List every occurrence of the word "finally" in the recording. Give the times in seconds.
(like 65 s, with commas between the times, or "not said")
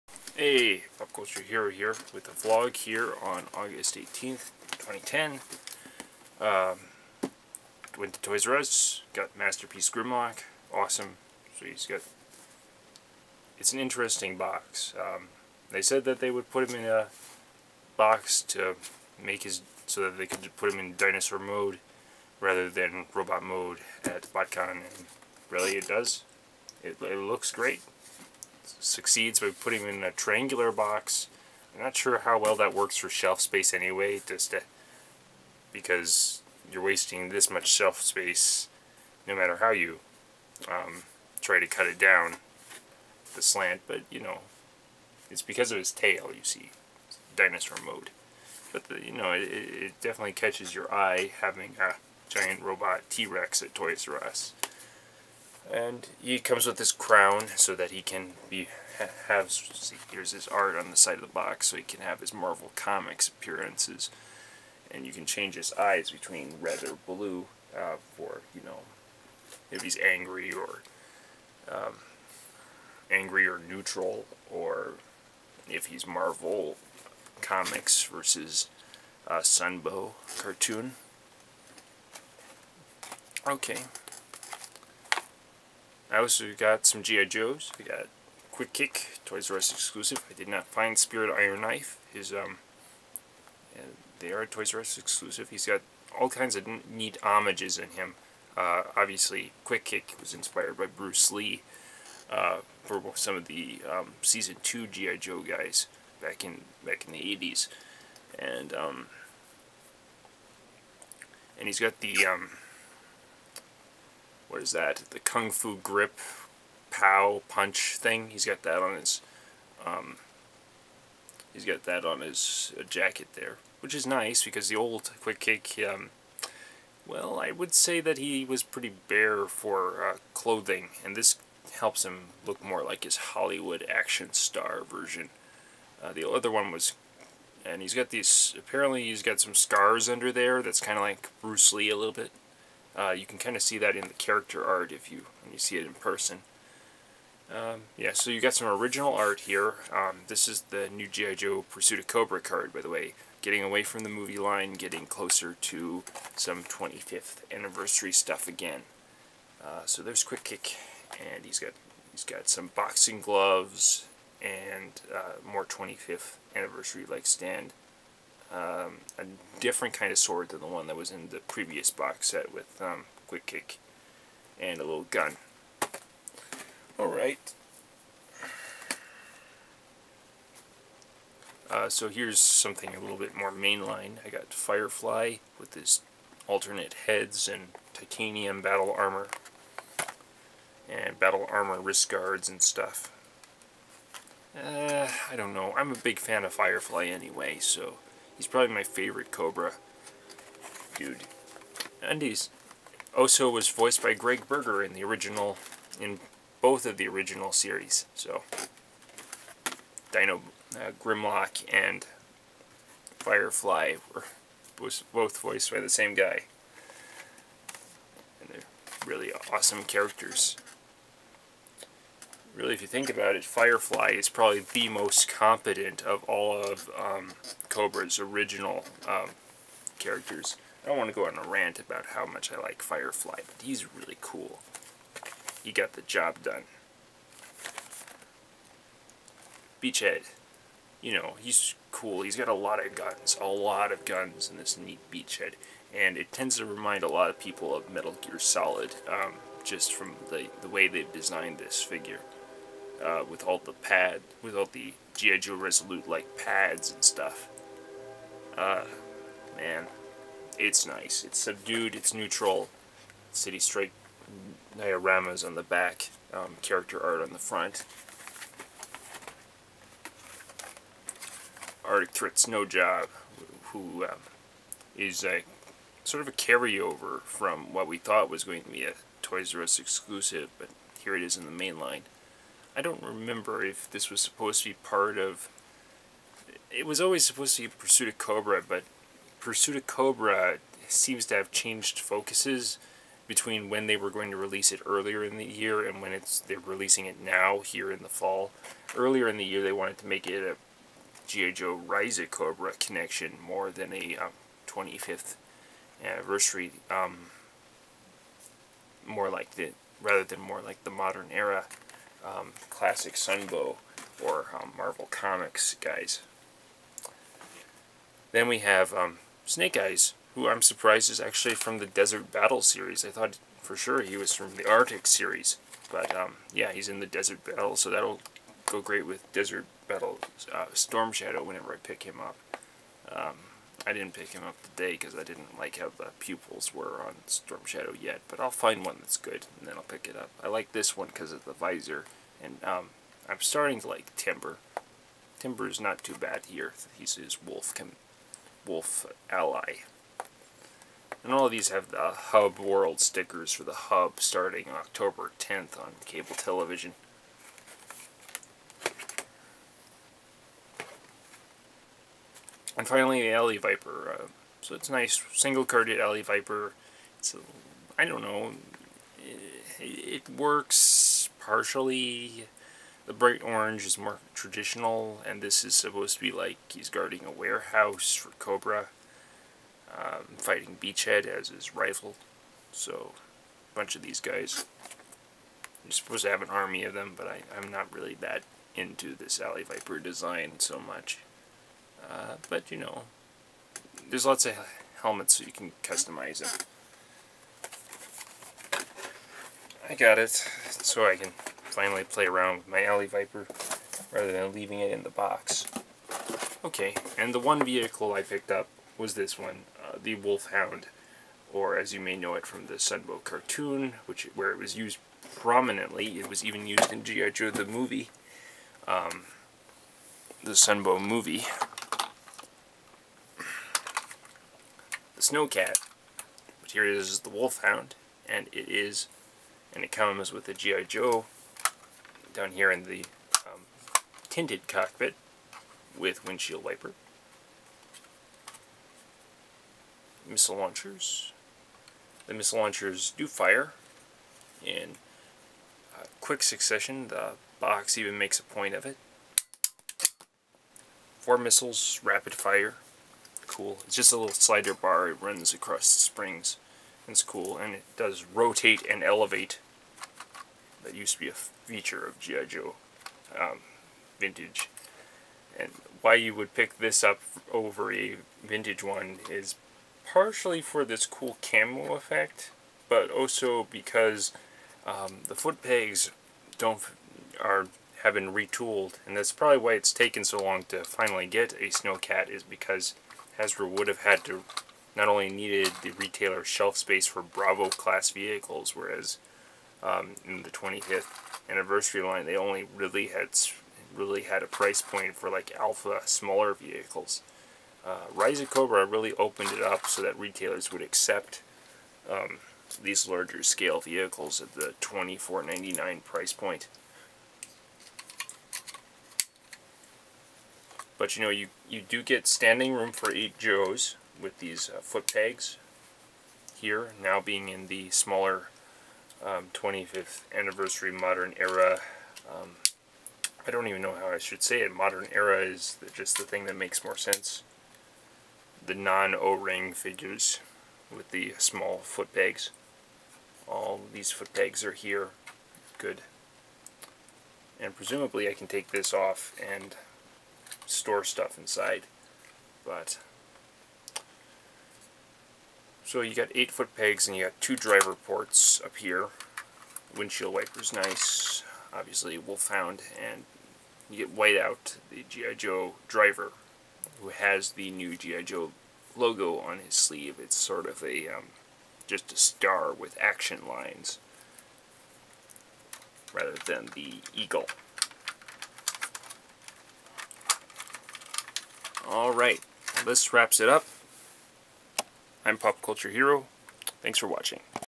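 362 s, 401 s, 480 s.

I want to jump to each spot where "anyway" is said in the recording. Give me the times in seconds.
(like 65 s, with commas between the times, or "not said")
33 s, 197 s.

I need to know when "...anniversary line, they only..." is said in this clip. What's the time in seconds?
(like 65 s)
491 s.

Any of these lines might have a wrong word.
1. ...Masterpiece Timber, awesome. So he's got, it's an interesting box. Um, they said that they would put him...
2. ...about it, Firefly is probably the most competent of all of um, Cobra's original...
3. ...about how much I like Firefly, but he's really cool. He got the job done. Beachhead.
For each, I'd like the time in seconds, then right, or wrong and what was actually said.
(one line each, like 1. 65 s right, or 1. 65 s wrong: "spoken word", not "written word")
1. 9 s wrong: "Grimlock", not "Timber"
2. 223 s right
3. 231 s right.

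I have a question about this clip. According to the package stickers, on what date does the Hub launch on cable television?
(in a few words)
October 10th.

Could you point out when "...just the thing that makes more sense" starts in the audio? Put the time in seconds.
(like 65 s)
525 s.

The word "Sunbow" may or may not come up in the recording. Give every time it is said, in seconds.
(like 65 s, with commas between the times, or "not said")
79 s, 313 s, 412 s, 420 s.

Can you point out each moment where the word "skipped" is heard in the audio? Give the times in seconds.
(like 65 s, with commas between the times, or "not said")
not said.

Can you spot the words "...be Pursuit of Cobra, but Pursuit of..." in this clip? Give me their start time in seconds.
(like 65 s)
287 s.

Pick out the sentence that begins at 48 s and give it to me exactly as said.
But the, you know, it, it definitely catches your eye having a giant robot T-Rex at Toys R Us.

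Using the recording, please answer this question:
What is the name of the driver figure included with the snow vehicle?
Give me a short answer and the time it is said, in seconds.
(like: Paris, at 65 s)
Whiteout, at 554 s.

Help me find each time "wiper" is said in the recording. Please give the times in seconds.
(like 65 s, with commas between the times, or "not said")
436 s, 550 s.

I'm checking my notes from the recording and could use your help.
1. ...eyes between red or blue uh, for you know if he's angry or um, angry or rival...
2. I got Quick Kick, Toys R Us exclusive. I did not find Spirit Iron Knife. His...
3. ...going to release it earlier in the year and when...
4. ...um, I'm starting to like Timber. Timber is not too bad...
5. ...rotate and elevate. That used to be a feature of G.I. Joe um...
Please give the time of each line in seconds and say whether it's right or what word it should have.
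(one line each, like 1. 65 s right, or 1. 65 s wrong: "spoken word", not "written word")
1. 65 s wrong: "neutral", not "rival"
2. 87 s right
3. 294 s right
4. 342 s right
5. 458 s right.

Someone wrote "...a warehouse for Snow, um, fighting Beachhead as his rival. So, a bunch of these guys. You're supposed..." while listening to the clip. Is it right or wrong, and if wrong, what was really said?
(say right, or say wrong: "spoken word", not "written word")
wrong: "Cobra", not "Snow".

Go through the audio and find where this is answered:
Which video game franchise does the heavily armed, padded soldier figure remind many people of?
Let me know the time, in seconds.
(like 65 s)
247 s.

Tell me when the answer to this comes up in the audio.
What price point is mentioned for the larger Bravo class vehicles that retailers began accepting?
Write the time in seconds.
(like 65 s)
504 s.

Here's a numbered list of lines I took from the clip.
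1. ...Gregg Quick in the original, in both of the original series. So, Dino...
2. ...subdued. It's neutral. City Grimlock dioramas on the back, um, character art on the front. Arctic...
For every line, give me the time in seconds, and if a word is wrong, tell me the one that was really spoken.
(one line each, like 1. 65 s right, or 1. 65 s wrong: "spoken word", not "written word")
1. 204 s wrong: "Berger", not "Quick"
2. 261 s wrong: "Strike", not "Grimlock".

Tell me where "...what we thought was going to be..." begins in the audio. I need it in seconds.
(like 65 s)
277 s.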